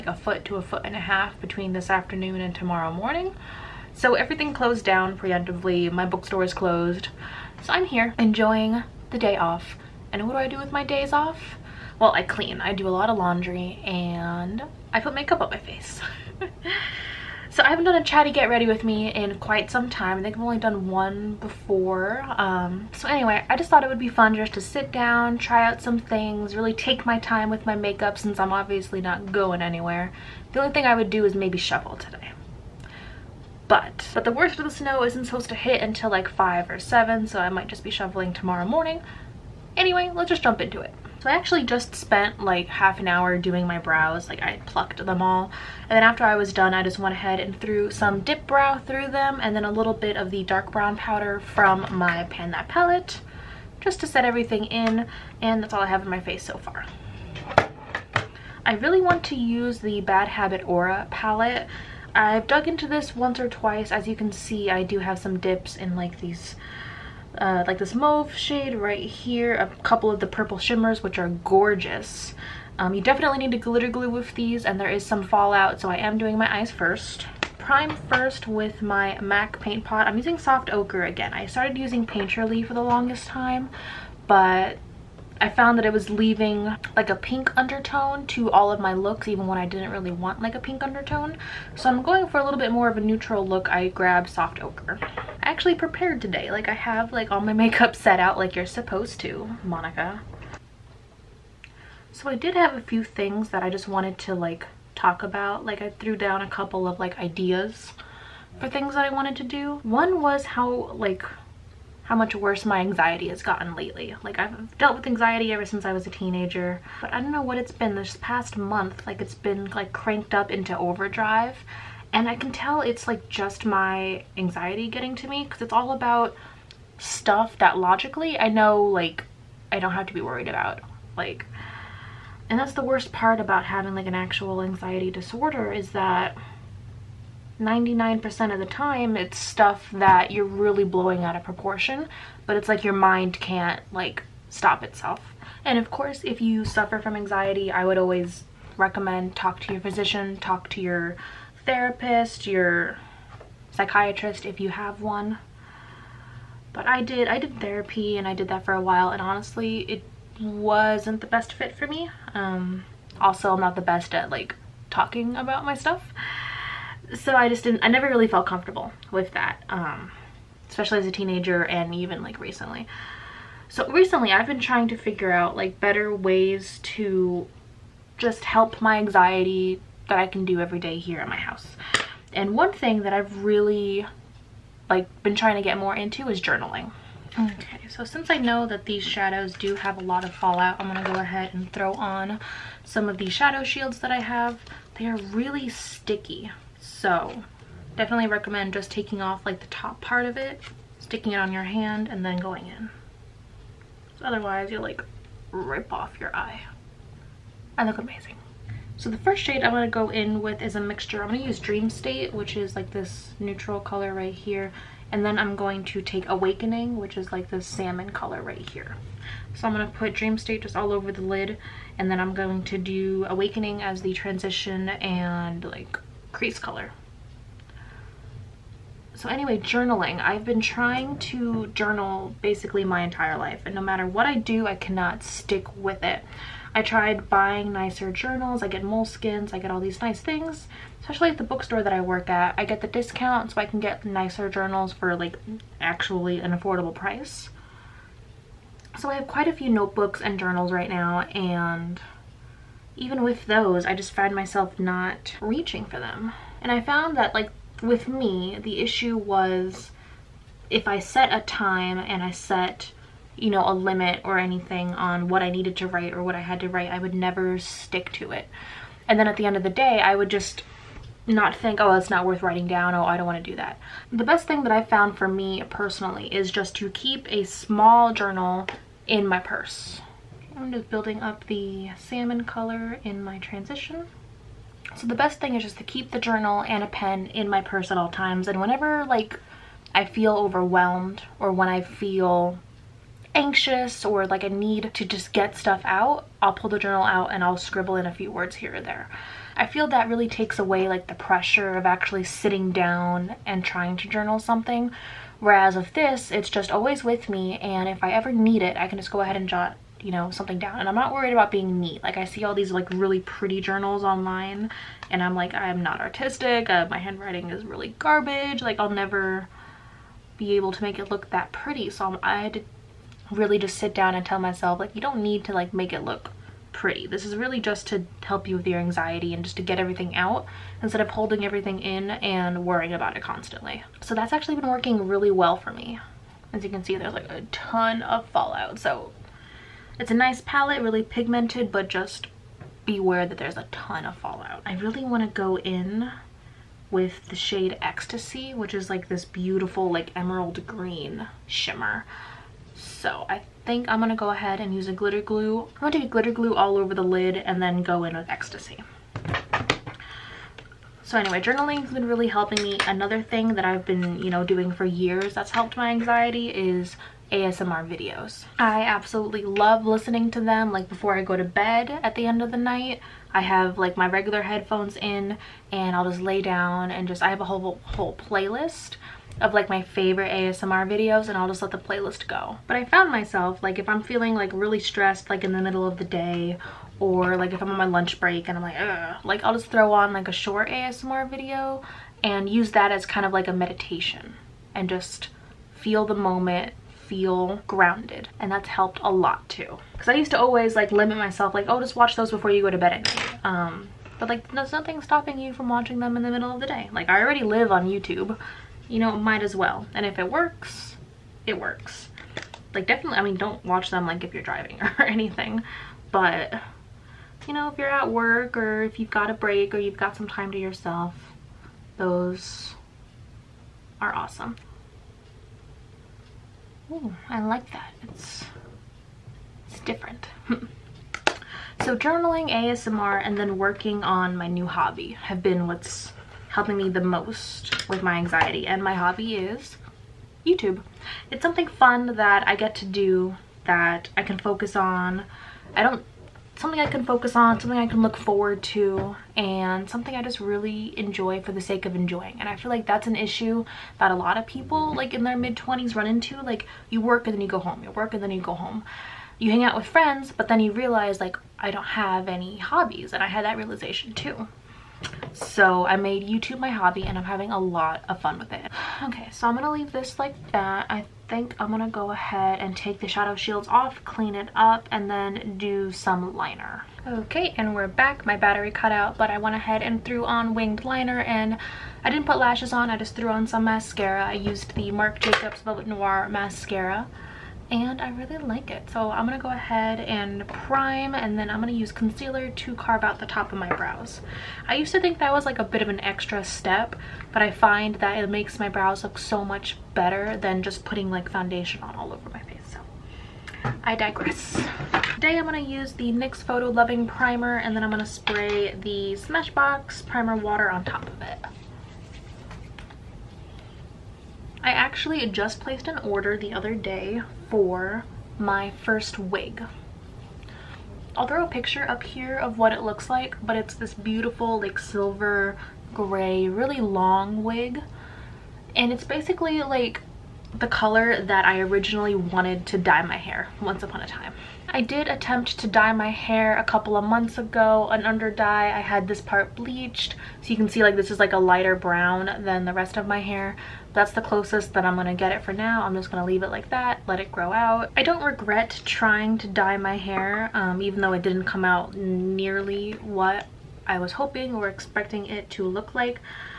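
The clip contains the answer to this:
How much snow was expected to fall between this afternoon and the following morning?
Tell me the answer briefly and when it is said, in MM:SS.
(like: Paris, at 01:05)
a foot to a foot and a half, at 00:00.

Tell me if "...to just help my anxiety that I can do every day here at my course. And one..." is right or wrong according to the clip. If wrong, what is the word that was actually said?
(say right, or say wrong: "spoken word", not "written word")
wrong: "house", not "course".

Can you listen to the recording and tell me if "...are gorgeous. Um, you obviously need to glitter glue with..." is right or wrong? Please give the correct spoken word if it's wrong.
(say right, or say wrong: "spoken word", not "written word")
wrong: "definitely", not "obviously".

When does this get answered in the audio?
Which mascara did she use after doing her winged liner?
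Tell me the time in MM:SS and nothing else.
08:04.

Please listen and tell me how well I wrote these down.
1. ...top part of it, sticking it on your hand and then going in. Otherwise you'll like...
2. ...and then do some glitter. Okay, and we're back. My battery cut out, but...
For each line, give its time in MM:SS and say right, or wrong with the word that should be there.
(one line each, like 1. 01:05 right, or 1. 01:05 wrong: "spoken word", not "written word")
1. 03:19 right
2. 07:54 wrong: "liner", not "glitter".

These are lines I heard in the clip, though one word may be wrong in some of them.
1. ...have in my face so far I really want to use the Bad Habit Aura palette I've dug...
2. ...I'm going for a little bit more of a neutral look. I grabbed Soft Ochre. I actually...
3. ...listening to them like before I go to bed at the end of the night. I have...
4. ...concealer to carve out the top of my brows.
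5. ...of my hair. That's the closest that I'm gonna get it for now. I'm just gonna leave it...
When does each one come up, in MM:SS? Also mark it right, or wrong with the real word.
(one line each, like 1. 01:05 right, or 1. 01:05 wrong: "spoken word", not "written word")
1. 00:55 right
2. 01:31 right
3. 06:09 right
4. 08:11 right
5. 09:02 right.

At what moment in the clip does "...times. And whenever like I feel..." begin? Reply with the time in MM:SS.
04:48.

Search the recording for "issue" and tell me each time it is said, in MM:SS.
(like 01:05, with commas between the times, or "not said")
04:18, 07:33.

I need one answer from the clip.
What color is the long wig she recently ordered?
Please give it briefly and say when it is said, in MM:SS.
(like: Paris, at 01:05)
silver gray, at 08:44.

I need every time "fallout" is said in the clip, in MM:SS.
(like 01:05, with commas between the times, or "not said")
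01:15, 03:10, 05:38, 05:44.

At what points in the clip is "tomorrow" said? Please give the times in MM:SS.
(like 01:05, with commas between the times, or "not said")
00:02, 00:38.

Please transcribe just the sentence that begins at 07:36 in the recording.
Like you work and then you go home, you work and then you go home.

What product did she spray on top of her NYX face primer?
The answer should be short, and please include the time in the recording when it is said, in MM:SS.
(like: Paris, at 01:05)
Smashbox Primer Water, at 08:29.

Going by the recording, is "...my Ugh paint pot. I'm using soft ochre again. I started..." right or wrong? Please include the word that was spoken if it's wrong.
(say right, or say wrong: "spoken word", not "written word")
wrong: "MAC", not "Ugh".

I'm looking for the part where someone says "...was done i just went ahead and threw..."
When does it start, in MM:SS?
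00:46.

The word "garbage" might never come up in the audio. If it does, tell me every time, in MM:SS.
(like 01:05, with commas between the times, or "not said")
05:17.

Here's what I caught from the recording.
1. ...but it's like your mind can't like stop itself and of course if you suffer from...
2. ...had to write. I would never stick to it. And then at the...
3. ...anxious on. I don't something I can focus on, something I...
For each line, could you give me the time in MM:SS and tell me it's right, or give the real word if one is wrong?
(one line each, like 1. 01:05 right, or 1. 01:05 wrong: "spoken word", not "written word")
1. 02:22 right
2. 04:26 right
3. 07:24 wrong: "focus", not "anxious".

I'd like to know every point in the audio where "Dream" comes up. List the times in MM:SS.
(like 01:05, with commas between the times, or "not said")
03:31, 03:40.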